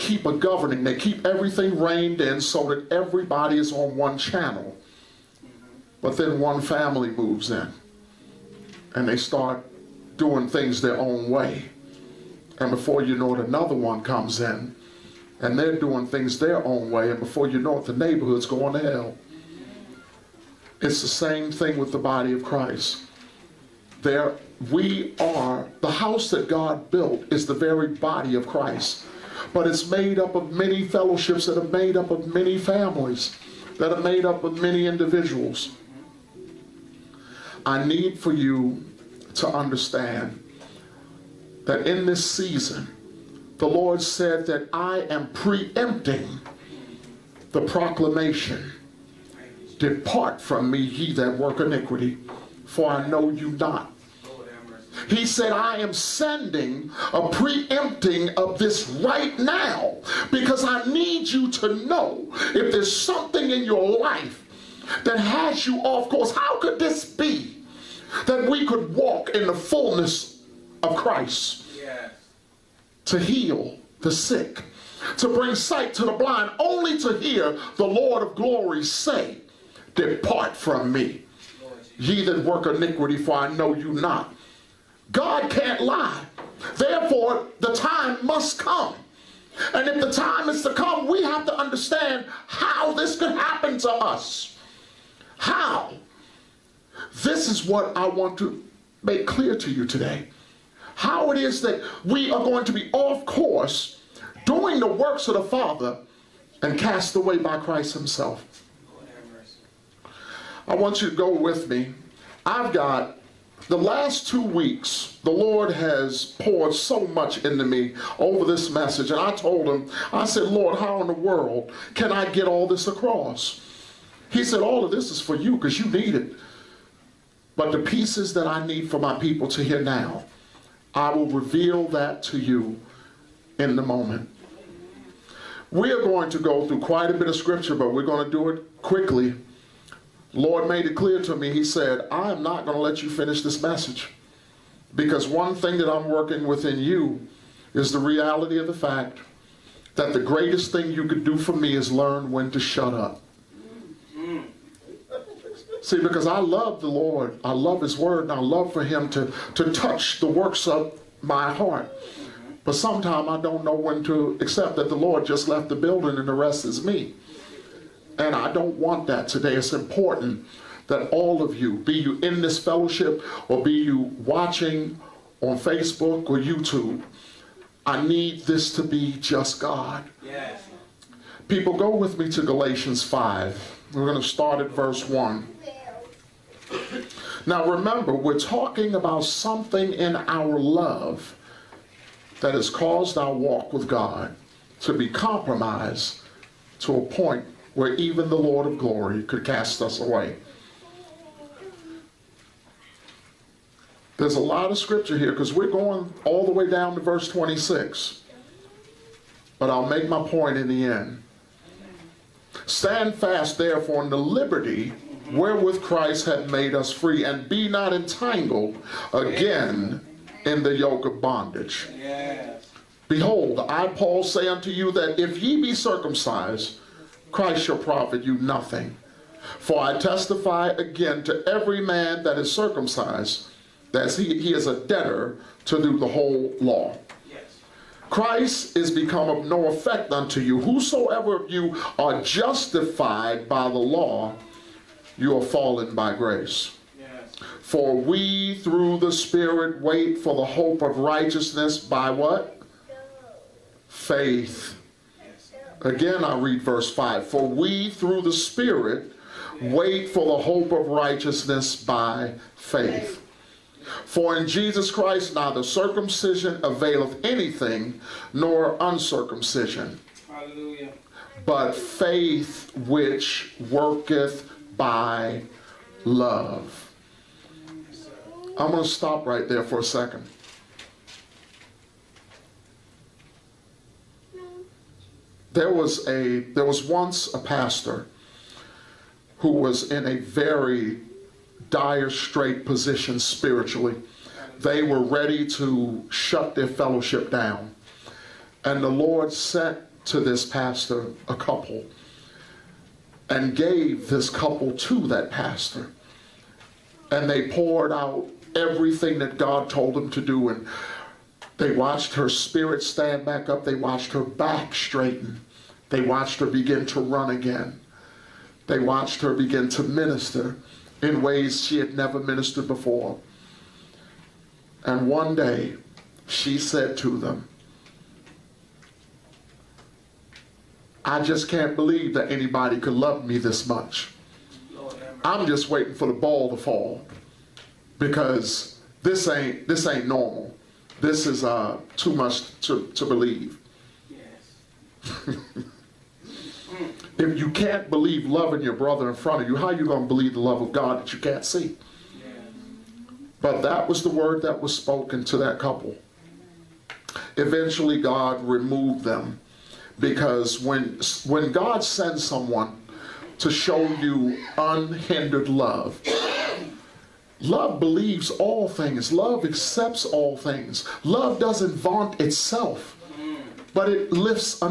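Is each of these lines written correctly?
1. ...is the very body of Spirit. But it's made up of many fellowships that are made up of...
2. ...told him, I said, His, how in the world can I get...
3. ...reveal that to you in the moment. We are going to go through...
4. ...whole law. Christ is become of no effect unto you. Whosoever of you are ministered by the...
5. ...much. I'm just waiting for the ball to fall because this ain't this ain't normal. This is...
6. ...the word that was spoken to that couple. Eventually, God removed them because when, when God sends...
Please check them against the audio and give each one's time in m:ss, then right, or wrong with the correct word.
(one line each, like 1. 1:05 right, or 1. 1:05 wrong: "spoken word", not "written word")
1. 0:27 wrong: "Christ", not "Spirit"
2. 1:59 wrong: "Lord", not "His"
3. 2:11 right
4. 3:56 wrong: "justified", not "ministered"
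5. 5:33 right
6. 5:54 right.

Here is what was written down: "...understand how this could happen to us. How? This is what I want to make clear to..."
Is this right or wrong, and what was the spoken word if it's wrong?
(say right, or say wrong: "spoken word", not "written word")
right.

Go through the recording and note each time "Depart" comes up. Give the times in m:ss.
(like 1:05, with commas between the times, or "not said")
0:49, 1:19.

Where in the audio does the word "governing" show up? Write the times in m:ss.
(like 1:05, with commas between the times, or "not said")
0:00.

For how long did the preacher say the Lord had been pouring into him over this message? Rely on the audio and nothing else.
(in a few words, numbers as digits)
Two weeks.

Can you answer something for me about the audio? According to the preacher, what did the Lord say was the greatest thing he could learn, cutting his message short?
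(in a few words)
When to shut up.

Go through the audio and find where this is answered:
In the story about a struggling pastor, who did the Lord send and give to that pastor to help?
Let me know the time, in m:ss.
5:01.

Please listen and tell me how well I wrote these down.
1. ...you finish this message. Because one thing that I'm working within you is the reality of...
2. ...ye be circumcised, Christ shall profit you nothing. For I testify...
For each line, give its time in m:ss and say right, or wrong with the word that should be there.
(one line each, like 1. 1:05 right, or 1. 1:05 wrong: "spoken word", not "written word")
1. 2:23 right
2. 3:45 right.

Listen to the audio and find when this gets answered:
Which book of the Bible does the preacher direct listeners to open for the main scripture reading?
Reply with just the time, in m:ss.
3:02.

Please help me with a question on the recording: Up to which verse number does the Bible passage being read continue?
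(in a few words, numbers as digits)
26.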